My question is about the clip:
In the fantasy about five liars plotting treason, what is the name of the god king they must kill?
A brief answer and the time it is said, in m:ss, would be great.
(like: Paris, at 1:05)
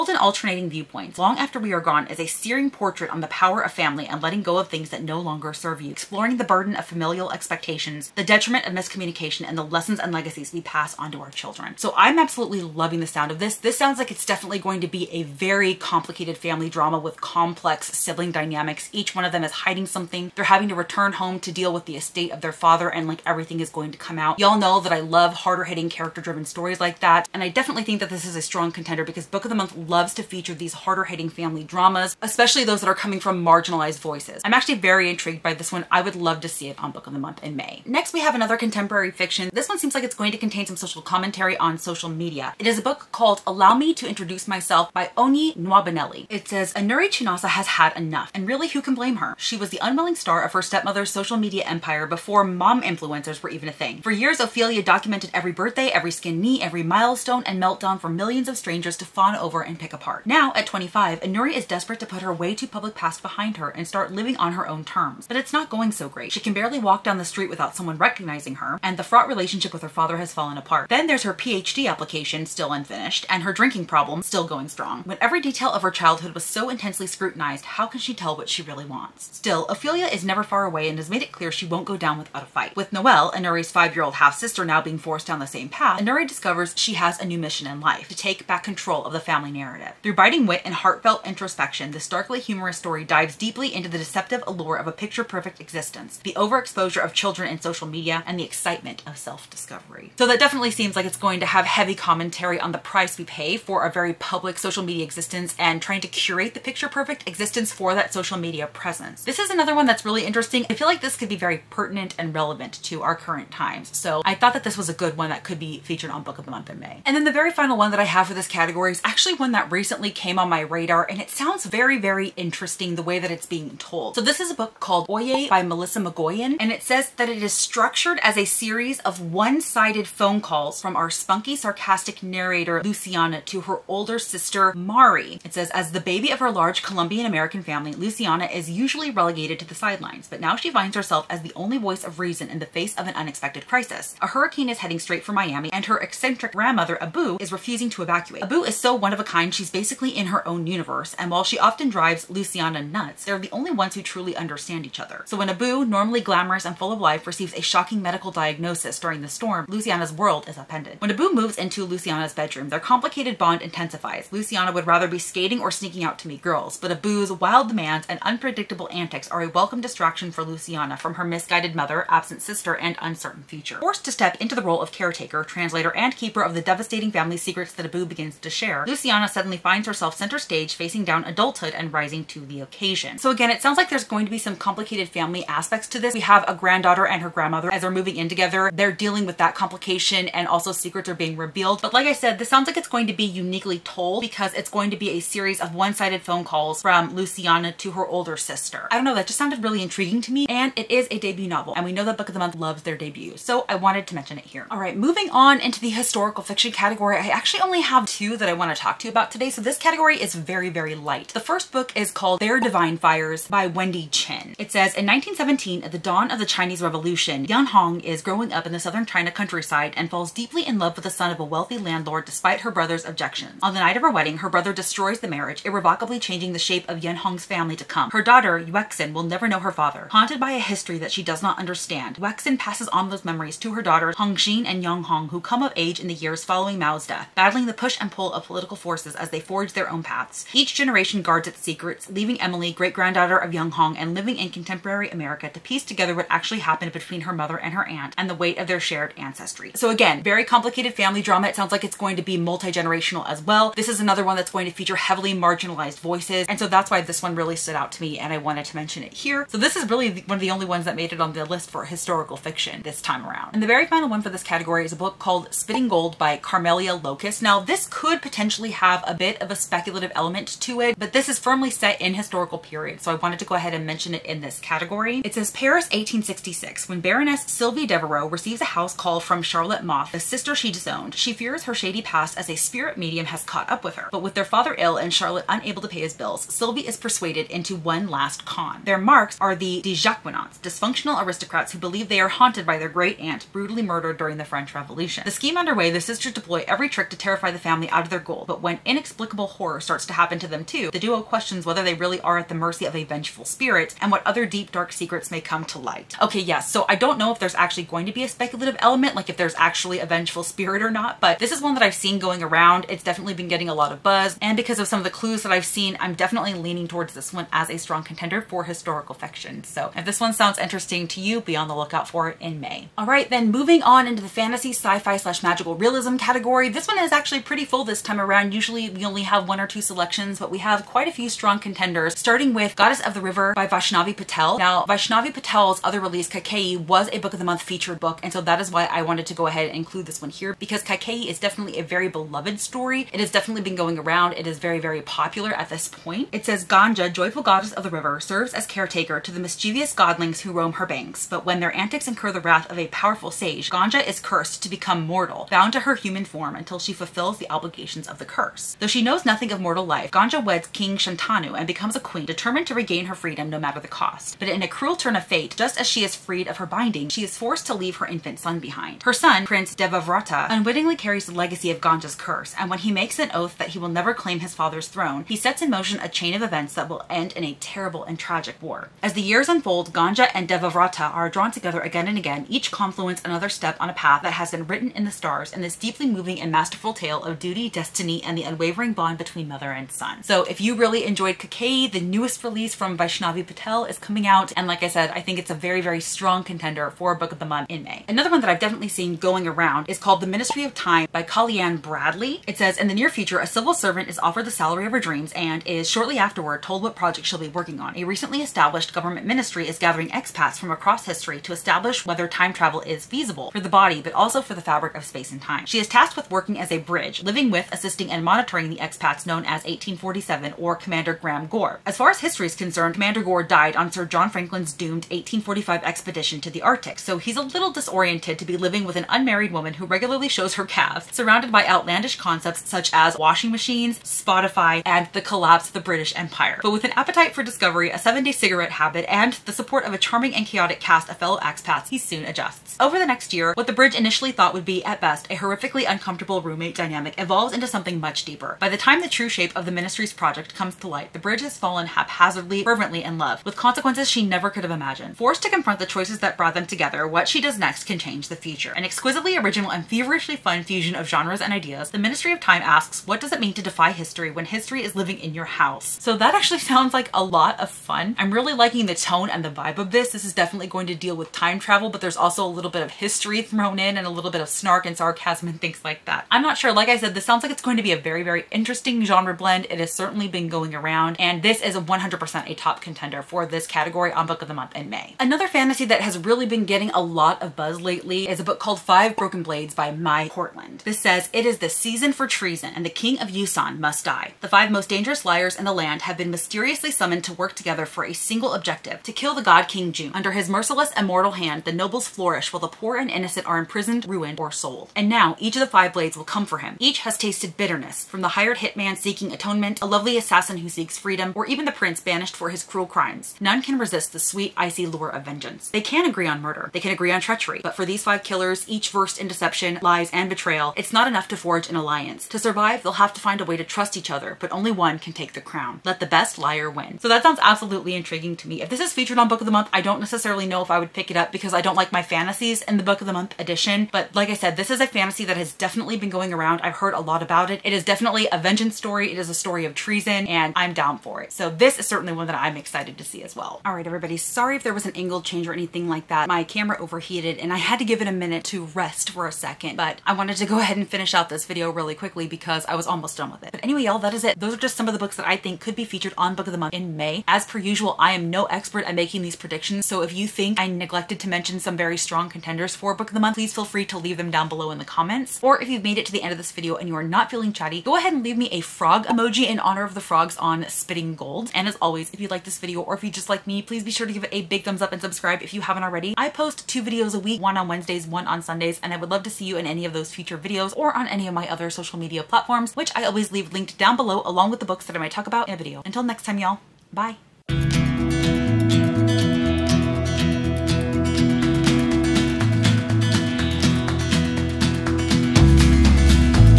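King Jun, at 8:19.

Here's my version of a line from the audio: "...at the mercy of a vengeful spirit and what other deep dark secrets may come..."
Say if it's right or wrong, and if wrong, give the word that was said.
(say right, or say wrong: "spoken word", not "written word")
right.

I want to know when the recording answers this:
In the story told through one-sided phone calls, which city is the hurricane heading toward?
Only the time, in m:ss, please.
2:25.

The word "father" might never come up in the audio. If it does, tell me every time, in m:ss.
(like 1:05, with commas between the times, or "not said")
0:22, 1:09, 3:49, 4:44, 6:14.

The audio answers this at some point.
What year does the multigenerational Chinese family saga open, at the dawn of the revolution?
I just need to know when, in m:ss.
3:35.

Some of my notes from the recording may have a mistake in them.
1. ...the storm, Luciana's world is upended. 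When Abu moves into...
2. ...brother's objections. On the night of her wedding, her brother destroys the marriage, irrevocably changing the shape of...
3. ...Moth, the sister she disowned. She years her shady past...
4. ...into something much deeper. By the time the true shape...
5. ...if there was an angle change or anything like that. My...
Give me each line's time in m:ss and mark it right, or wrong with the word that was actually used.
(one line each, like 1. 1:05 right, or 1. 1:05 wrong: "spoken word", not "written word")
1. 2:39 right
2. 3:42 right
3. 4:39 wrong: "fears", not "years"
4. 7:27 right
5. 9:04 right.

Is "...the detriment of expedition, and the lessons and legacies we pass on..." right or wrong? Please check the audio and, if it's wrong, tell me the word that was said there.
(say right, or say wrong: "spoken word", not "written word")
wrong: "miscommunication", not "expedition".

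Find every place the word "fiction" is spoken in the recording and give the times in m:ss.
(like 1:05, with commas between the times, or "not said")
0:39, 3:26, 4:22, 5:19.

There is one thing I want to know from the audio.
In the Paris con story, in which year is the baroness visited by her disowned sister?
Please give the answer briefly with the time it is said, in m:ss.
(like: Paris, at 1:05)
1866, at 4:35.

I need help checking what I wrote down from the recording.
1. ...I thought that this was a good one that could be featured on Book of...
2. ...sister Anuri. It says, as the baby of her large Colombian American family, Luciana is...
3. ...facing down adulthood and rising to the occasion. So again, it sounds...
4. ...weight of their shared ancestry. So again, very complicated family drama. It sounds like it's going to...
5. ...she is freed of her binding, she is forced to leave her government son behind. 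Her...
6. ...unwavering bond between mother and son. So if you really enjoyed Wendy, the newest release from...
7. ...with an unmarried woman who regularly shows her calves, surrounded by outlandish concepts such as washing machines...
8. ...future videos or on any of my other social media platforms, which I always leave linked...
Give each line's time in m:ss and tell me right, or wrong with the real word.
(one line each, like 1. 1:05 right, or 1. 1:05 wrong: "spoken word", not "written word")
1. 1:54 right
2. 2:14 wrong: "Mari", not "Anuri"
3. 3:00 right
4. 4:08 right
5. 6:05 wrong: "infant", not "government"
6. 6:28 wrong: "Kaikeyi", not "Wendy"
7. 7:08 right
8. 9:40 right.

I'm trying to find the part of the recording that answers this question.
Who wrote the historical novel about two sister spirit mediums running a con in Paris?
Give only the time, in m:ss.
4:26.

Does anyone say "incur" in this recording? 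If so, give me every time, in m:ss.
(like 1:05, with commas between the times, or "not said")
5:52.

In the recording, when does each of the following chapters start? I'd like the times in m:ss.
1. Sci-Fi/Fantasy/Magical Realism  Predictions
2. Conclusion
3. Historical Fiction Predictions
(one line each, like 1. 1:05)
1. 5:23
2. 9:03
3. 3:24.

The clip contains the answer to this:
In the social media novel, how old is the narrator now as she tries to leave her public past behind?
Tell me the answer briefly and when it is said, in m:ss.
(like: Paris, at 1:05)
25, at 1:00.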